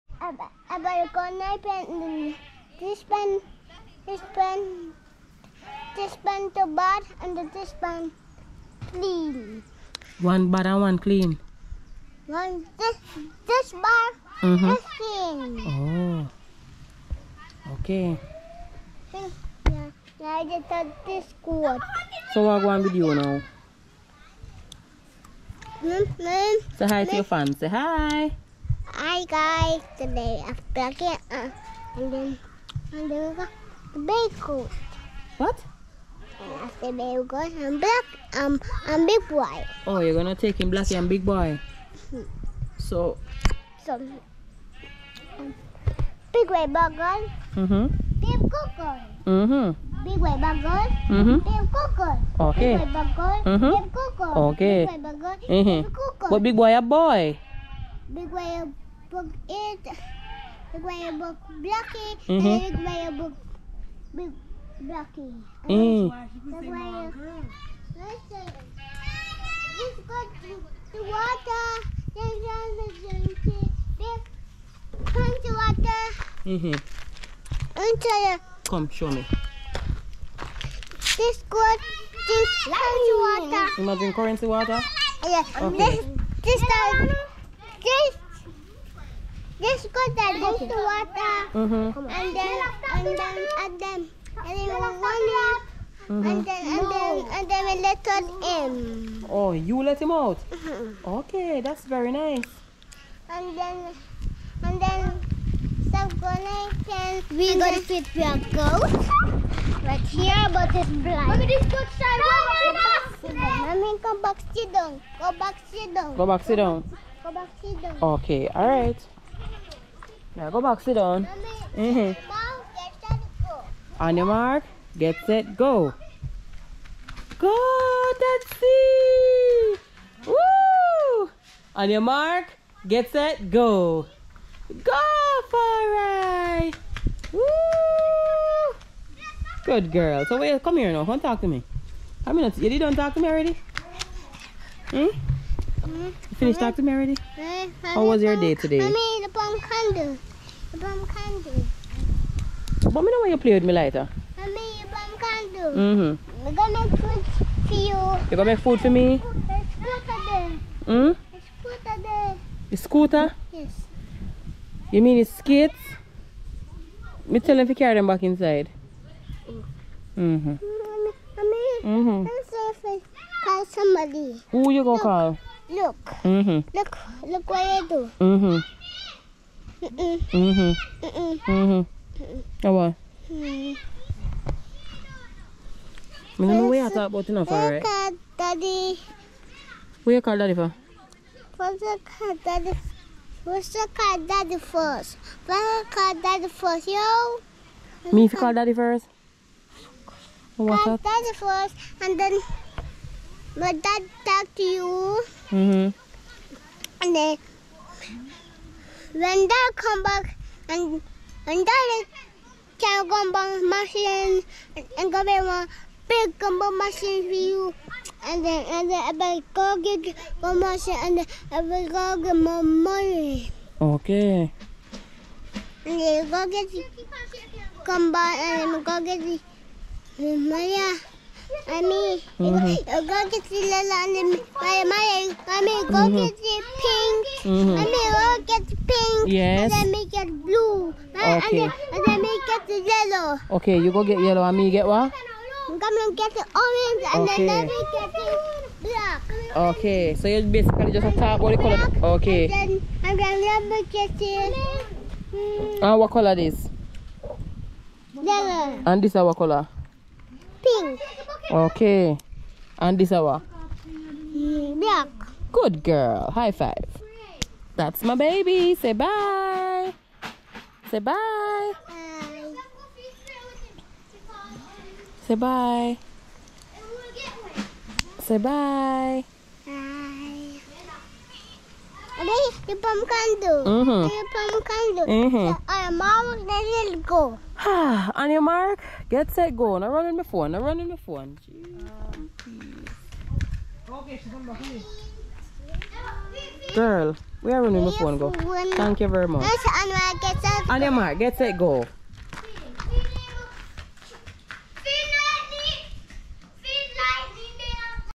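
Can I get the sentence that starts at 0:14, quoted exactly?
this clean oh okay yeah, I just thought this good so what one video now mm -hmm.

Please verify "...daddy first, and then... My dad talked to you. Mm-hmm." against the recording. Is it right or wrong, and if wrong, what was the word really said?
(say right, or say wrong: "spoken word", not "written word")
right.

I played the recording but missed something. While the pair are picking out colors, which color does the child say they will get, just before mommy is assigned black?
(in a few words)
orange.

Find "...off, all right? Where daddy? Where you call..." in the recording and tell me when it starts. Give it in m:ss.
3:07.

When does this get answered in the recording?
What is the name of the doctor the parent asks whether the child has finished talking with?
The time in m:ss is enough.
2:26.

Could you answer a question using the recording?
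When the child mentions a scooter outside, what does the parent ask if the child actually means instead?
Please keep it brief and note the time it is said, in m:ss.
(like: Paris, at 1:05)
skates, at 2:45.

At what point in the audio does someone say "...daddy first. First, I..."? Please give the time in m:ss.
3:14.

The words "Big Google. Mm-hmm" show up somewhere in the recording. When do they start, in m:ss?
0:48.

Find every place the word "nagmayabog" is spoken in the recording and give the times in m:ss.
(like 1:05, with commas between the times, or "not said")
1:00, 1:06.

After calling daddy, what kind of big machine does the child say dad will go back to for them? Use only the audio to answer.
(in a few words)
gumball machine.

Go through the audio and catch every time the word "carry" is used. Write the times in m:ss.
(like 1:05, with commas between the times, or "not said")
2:47.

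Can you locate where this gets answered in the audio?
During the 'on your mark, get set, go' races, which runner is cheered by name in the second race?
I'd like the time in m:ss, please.
2:15.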